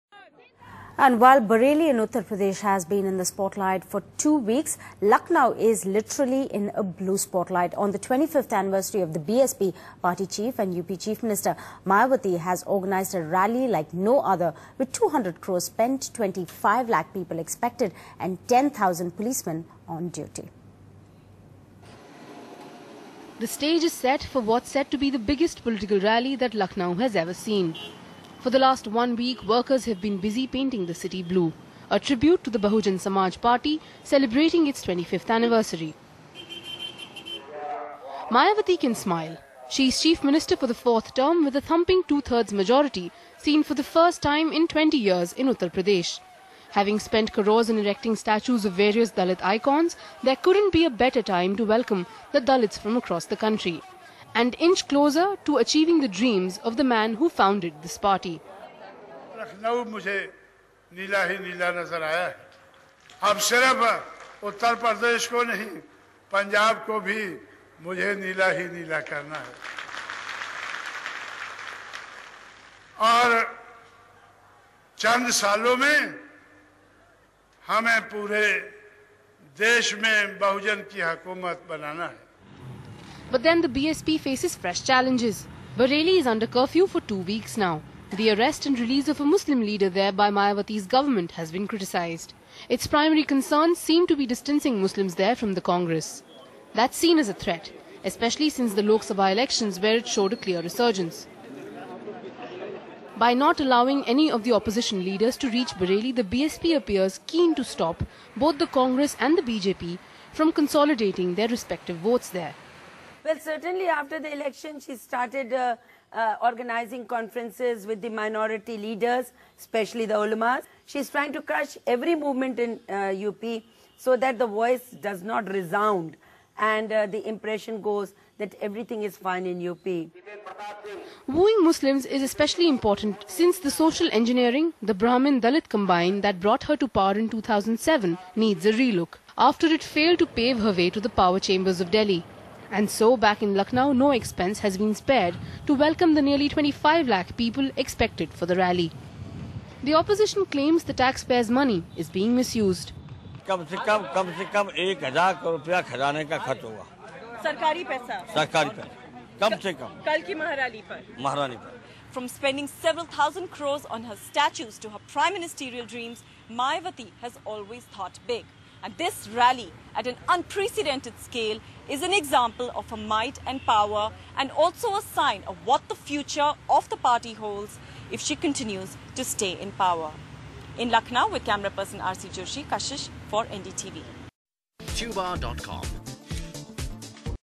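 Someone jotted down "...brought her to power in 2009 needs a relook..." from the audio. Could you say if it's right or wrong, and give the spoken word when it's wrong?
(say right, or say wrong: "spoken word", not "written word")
wrong: "2007", not "2009".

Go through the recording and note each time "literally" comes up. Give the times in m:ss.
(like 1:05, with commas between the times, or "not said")
0:05.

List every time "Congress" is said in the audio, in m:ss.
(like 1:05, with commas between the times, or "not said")
1:35, 1:48.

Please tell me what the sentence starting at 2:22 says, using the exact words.
And so, back in Lucknow, no expense has been spared to welcome the nearly 25 lakh people expected for the rally.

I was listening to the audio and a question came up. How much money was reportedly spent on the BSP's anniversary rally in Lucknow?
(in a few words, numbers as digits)
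200 crores.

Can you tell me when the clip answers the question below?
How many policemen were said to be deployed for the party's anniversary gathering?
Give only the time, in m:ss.
0:18.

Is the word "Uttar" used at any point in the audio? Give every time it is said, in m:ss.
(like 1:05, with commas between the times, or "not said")
0:01, 0:45.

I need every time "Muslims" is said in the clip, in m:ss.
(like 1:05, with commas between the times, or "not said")
1:29, 1:34, 2:11.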